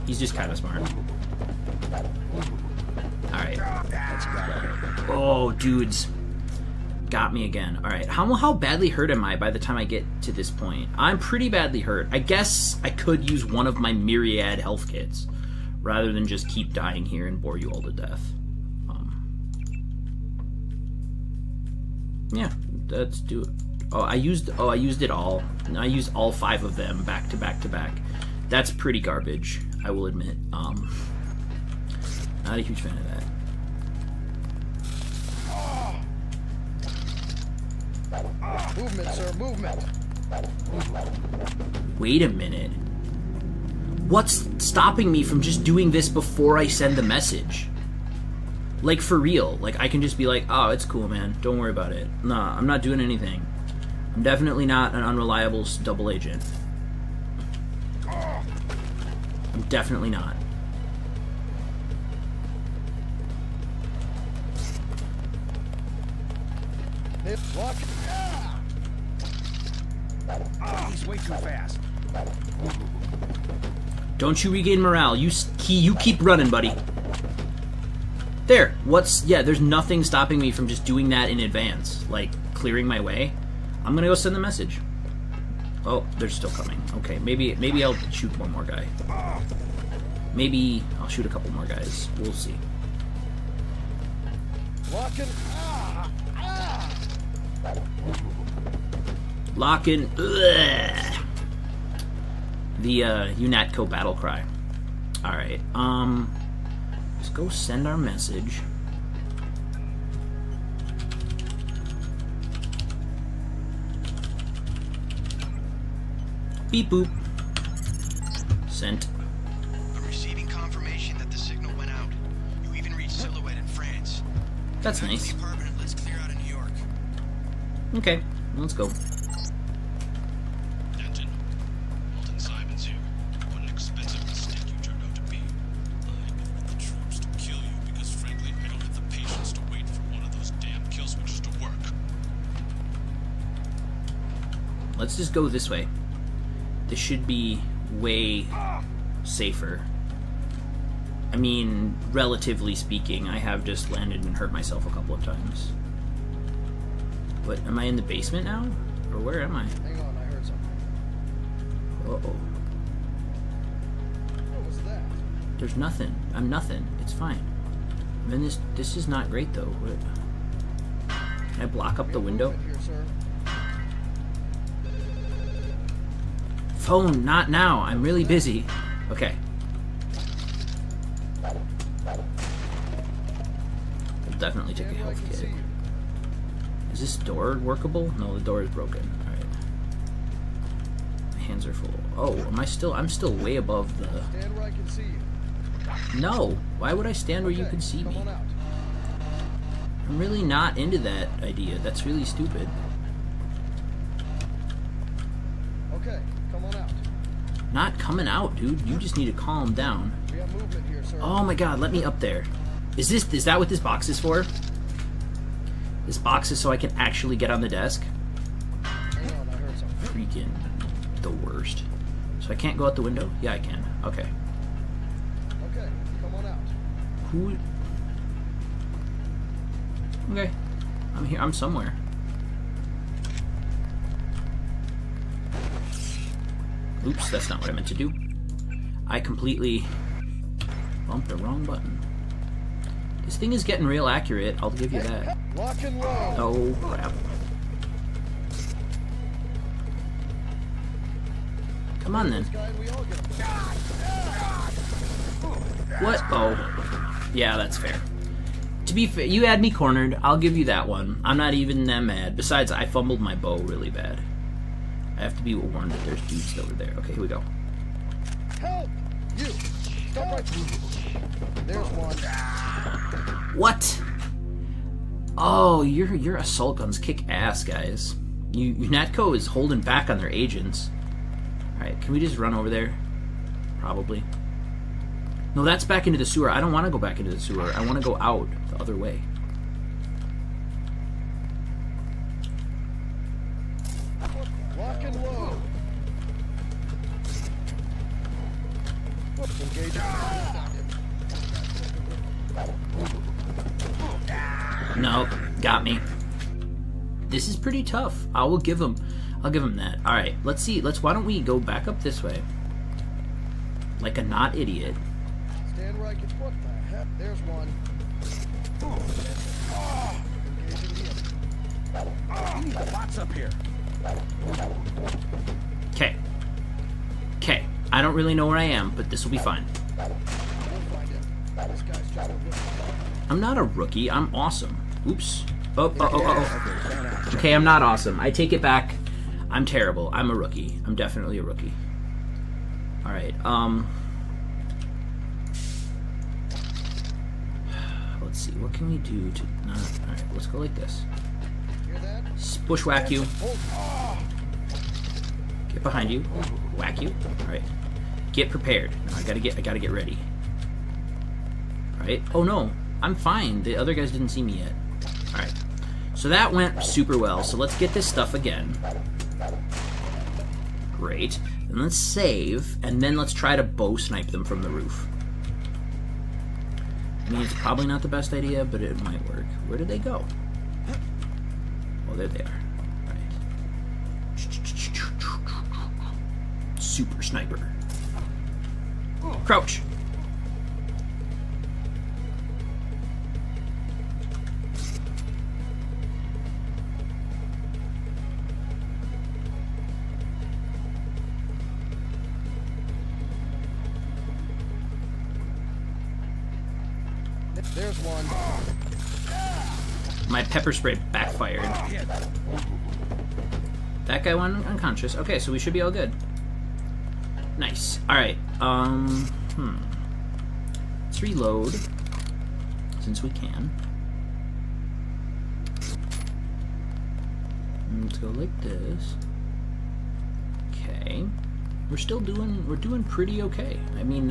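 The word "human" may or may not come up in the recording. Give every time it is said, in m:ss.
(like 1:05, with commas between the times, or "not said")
not said.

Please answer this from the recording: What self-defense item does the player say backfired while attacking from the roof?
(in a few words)
pepper spray.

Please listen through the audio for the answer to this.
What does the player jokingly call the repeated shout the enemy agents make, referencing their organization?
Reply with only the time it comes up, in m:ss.
1:43.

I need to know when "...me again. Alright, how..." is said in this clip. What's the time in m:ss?
0:07.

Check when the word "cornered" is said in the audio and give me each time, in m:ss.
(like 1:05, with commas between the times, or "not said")
4:19.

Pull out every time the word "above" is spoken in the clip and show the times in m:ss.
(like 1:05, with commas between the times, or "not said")
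3:13.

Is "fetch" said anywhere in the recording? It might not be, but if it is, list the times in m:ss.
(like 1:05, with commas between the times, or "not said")
not said.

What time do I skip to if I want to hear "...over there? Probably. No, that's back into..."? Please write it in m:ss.
4:42.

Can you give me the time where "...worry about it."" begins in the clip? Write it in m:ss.
0:51.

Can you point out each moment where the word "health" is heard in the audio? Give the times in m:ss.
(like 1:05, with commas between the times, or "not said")
0:14, 3:04.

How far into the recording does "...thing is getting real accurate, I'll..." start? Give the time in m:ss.
4:03.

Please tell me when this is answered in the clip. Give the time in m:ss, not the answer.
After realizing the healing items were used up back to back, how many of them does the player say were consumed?
0:26.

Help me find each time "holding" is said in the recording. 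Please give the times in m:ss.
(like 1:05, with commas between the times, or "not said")
4:39.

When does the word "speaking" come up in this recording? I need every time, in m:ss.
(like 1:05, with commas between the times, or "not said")
2:32.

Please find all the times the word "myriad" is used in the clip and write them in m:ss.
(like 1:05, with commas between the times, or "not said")
0:13.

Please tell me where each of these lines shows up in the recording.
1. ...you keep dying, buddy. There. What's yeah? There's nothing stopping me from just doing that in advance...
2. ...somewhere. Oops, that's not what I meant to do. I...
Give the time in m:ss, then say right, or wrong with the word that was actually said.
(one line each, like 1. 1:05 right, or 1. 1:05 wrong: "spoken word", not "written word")
1. 1:15 wrong: "running", not "dying"
2. 3:51 right.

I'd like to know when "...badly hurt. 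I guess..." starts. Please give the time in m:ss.
0:11.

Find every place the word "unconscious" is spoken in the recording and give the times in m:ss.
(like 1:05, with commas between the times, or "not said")
6:54.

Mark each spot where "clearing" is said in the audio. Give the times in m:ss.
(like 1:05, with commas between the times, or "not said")
1:22.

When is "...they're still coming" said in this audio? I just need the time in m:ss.
1:26.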